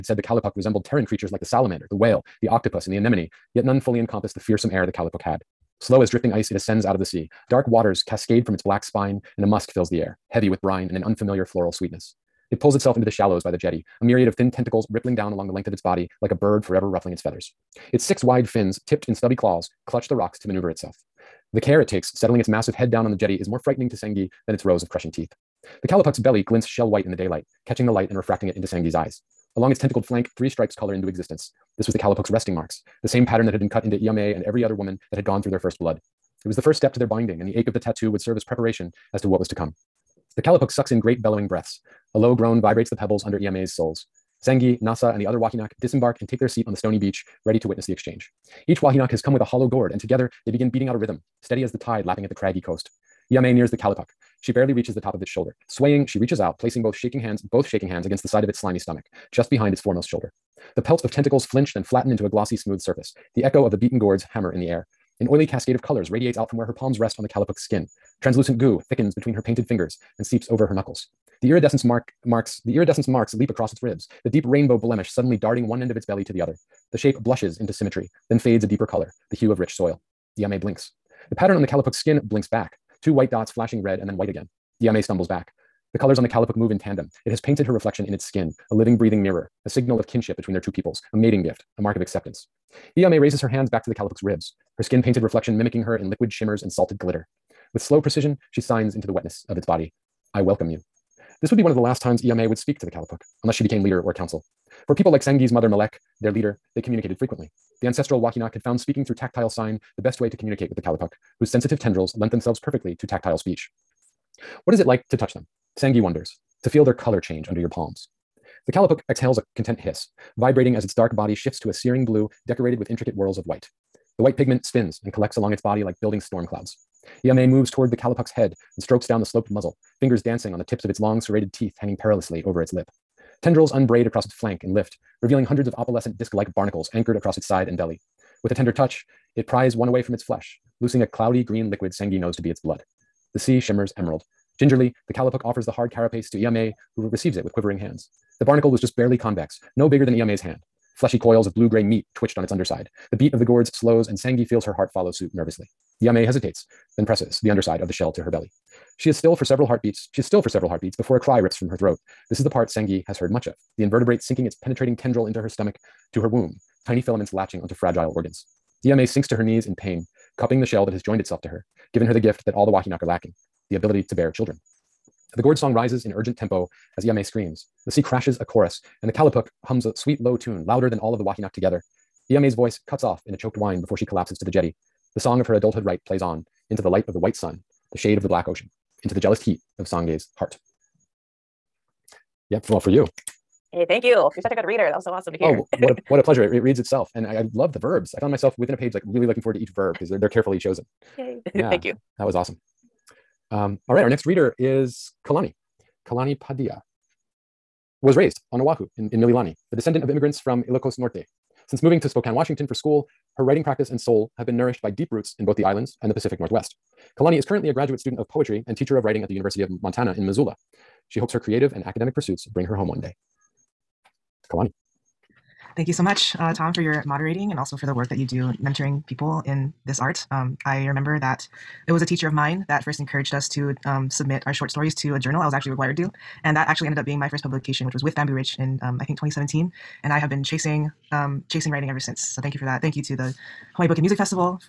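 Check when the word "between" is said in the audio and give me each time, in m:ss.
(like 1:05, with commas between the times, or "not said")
1:09, 1:30.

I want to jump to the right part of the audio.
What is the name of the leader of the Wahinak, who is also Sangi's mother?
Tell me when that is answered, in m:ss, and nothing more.
1:45.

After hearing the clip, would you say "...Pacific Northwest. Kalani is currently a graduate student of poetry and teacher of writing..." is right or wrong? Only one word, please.
right.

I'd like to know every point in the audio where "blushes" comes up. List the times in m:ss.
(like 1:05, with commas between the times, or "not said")
1:17.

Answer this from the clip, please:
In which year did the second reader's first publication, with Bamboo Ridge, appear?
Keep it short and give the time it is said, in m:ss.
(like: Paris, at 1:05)
2017, at 3:59.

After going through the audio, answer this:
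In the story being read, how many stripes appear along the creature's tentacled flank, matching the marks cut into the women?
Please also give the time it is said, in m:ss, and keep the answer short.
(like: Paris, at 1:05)
3, at 0:30.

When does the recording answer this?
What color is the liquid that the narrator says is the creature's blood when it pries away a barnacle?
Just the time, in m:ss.
2:21.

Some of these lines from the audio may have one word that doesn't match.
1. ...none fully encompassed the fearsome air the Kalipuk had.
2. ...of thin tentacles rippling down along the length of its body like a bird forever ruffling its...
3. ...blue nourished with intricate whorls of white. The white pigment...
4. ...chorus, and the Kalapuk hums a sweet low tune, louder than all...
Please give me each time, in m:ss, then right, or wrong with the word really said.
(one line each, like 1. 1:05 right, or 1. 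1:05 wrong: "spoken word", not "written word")
1. 0:03 right
2. 0:14 right
3. 2:02 wrong: "decorated", not "nourished"
4. 2:58 right.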